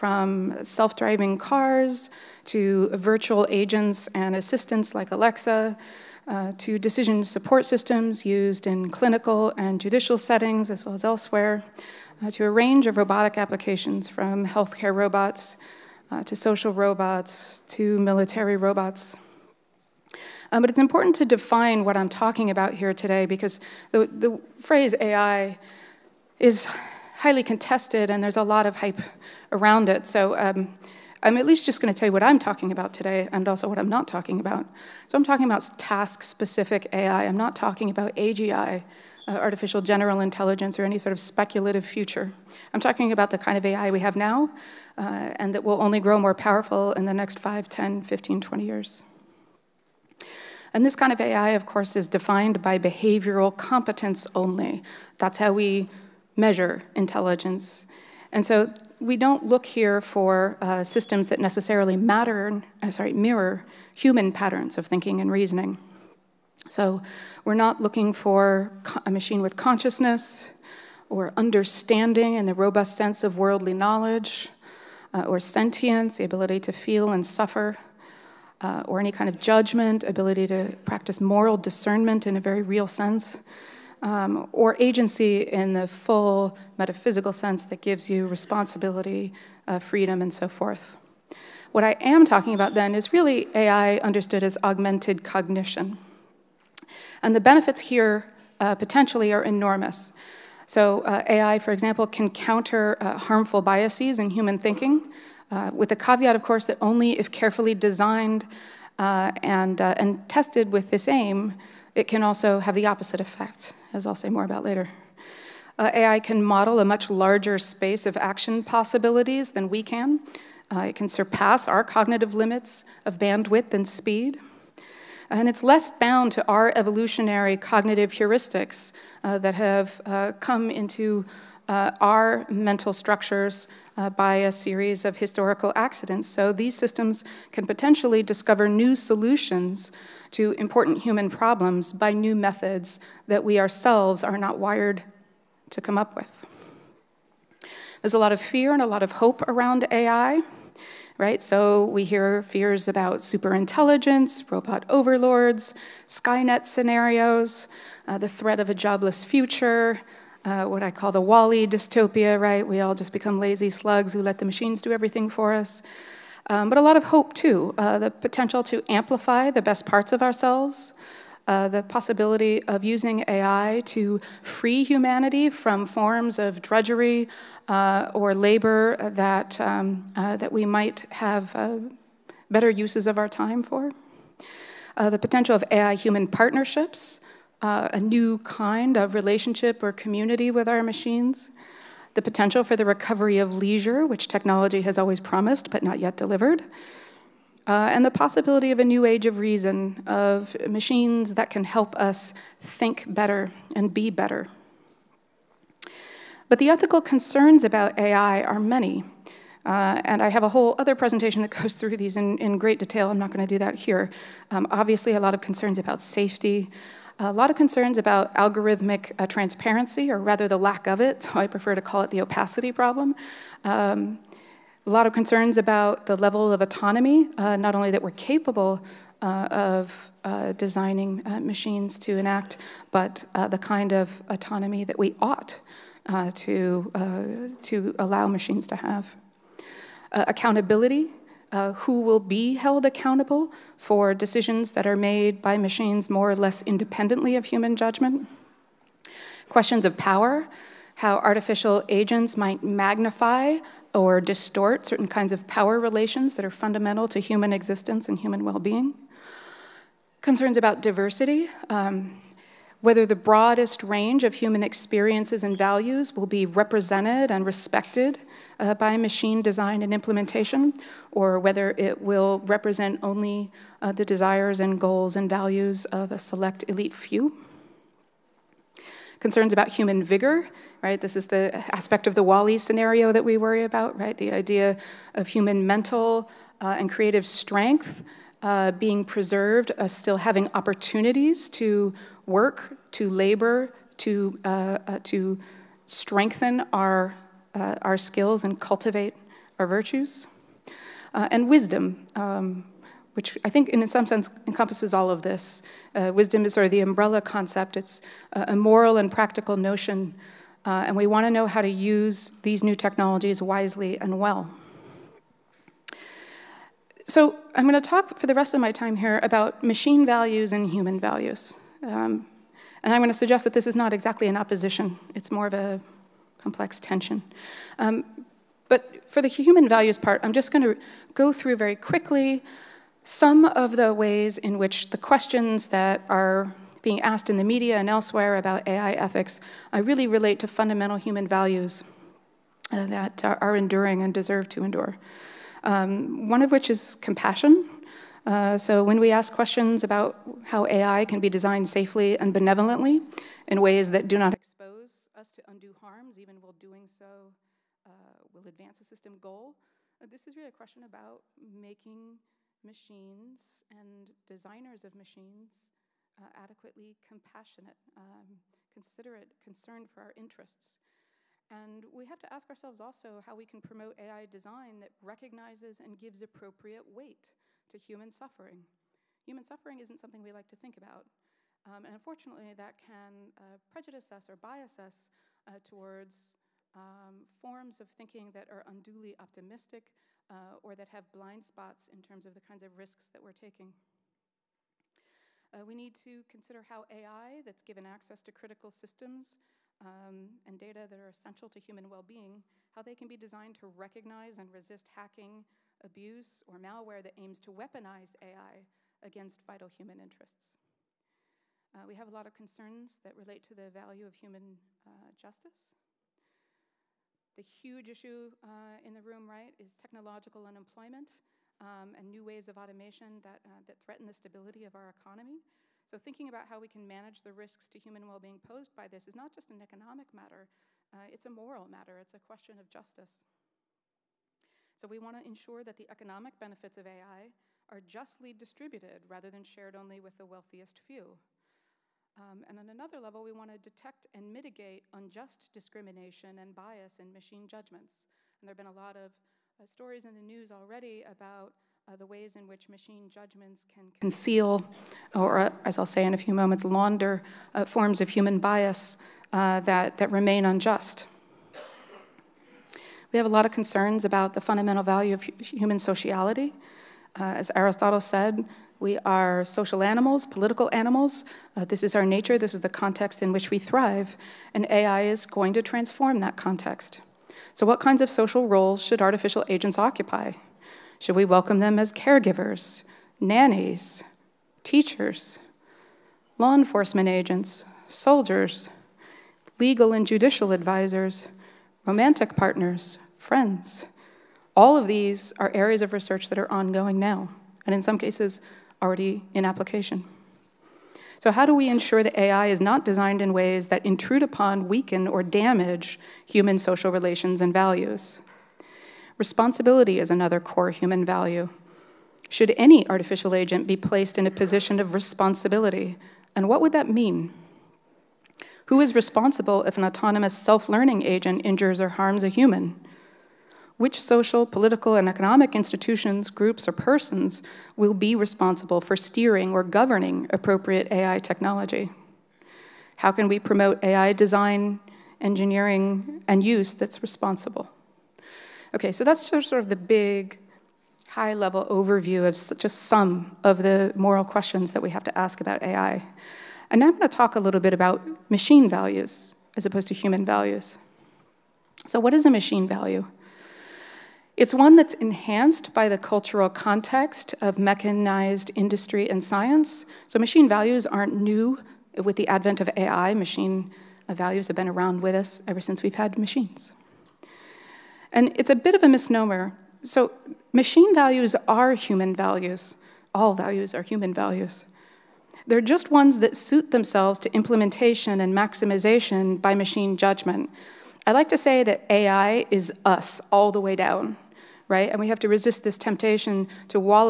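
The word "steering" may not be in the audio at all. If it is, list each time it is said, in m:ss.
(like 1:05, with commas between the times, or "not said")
8:48.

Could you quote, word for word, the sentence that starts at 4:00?
accountability uh, who will be held accountable for decisions that are made by machines more or less independently of human judgment.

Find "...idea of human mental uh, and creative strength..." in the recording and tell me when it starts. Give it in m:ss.
4:44.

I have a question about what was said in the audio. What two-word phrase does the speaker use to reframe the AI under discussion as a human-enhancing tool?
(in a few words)
augmented cognition.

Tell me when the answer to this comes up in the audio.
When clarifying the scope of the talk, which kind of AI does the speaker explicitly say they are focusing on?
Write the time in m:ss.
0:35.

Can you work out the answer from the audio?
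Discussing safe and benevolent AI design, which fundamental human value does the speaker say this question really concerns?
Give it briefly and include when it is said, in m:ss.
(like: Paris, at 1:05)
compassion, at 5:46.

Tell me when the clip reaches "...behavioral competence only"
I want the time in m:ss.
0:52.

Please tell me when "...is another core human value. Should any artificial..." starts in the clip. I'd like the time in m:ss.
8:29.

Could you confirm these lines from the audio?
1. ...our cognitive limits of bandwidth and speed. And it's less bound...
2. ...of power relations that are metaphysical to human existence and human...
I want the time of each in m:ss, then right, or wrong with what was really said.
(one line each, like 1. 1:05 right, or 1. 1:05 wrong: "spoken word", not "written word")
1. 2:01 right
2. 4:15 wrong: "fundamental", not "metaphysical".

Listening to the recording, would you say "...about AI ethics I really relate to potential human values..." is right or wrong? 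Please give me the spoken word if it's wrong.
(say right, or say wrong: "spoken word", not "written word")
wrong: "fundamental", not "potential".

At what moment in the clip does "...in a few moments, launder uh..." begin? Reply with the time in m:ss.
7:36.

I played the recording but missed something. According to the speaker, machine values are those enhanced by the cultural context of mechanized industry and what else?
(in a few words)
science.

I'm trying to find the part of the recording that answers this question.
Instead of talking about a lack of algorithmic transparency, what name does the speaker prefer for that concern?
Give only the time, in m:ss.
3:42.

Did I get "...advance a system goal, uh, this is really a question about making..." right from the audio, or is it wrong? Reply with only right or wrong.
right.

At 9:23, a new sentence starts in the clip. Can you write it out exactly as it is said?
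Machine values have been around with us ever since we've had machines.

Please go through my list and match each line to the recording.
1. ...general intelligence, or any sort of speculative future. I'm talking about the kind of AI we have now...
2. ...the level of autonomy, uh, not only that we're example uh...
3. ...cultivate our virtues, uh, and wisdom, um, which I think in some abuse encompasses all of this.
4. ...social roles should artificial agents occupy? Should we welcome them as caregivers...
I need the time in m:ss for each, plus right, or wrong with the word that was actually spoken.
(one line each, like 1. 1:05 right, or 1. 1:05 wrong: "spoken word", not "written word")
1. 0:39 right
2. 3:46 wrong: "capable", not "example"
3. 4:58 wrong: "sense", not "abuse"
4. 7:58 right.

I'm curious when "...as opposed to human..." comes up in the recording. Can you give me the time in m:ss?
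9:09.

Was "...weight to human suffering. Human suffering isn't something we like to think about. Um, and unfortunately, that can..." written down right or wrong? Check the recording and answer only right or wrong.
right.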